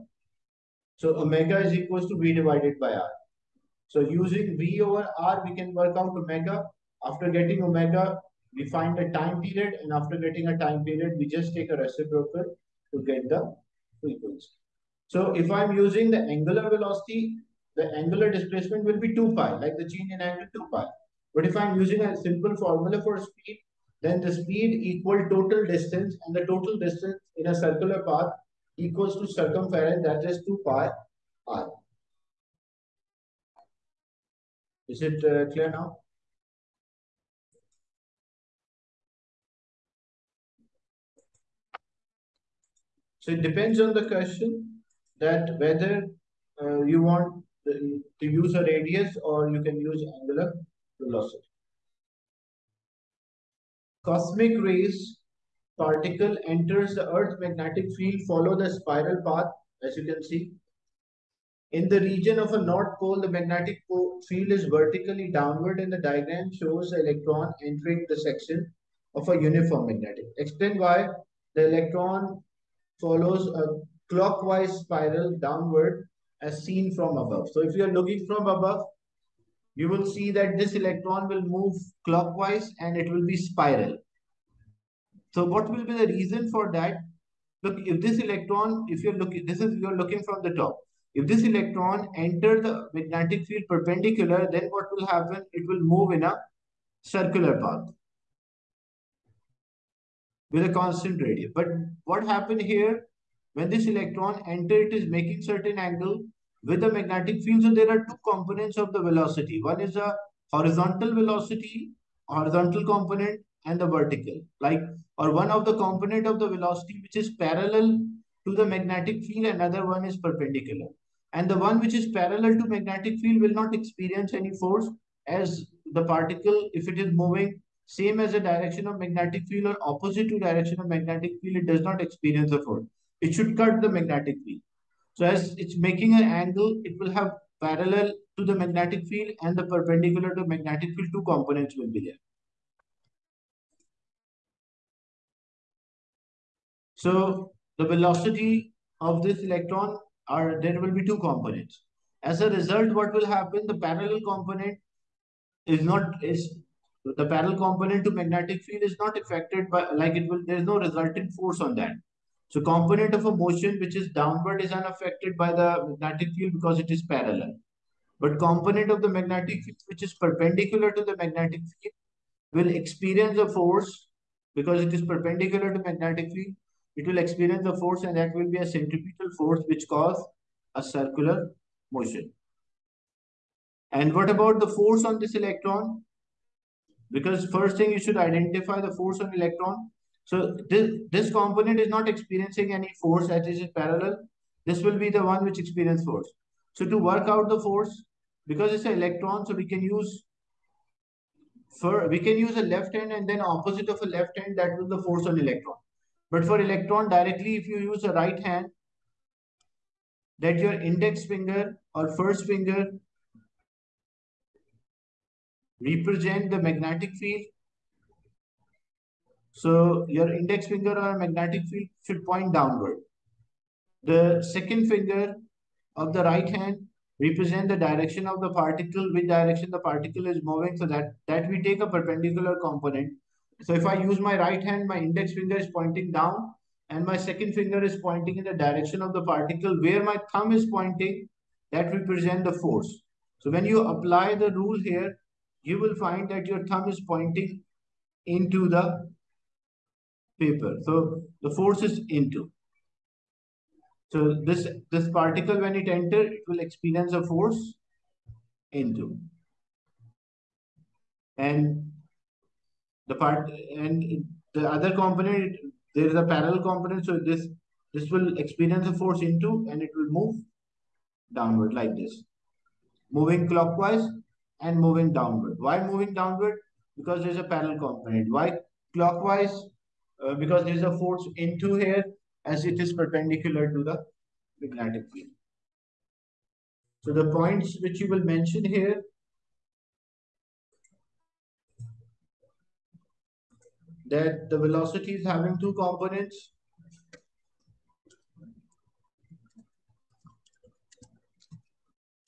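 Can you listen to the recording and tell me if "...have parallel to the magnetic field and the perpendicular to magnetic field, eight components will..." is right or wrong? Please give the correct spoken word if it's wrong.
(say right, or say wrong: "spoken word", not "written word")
wrong: "two", not "eight".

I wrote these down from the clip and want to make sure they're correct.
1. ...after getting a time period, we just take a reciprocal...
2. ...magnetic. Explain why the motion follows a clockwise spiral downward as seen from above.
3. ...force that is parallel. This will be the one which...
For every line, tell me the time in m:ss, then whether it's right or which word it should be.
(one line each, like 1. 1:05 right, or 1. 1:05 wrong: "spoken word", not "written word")
1. 0:09 right
2. 1:09 wrong: "electron", not "motion"
3. 3:13 right.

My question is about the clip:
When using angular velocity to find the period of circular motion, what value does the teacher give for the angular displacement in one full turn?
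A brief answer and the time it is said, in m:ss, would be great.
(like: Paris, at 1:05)
2 pi, at 0:19.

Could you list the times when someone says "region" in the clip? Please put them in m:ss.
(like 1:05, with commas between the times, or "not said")
1:02.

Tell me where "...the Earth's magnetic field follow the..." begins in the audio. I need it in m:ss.
0:56.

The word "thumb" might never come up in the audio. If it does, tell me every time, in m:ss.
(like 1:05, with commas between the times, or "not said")
4:00, 4:06.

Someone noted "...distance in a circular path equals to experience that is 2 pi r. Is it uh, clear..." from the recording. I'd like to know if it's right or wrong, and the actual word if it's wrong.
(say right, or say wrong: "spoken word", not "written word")
wrong: "circumference", not "experience".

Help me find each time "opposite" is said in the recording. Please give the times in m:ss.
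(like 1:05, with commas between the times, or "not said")
2:09, 3:23.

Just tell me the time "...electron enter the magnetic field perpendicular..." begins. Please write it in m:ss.
1:31.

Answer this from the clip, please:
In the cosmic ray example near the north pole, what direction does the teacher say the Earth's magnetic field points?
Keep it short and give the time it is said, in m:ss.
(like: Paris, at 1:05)
vertically downward, at 1:04.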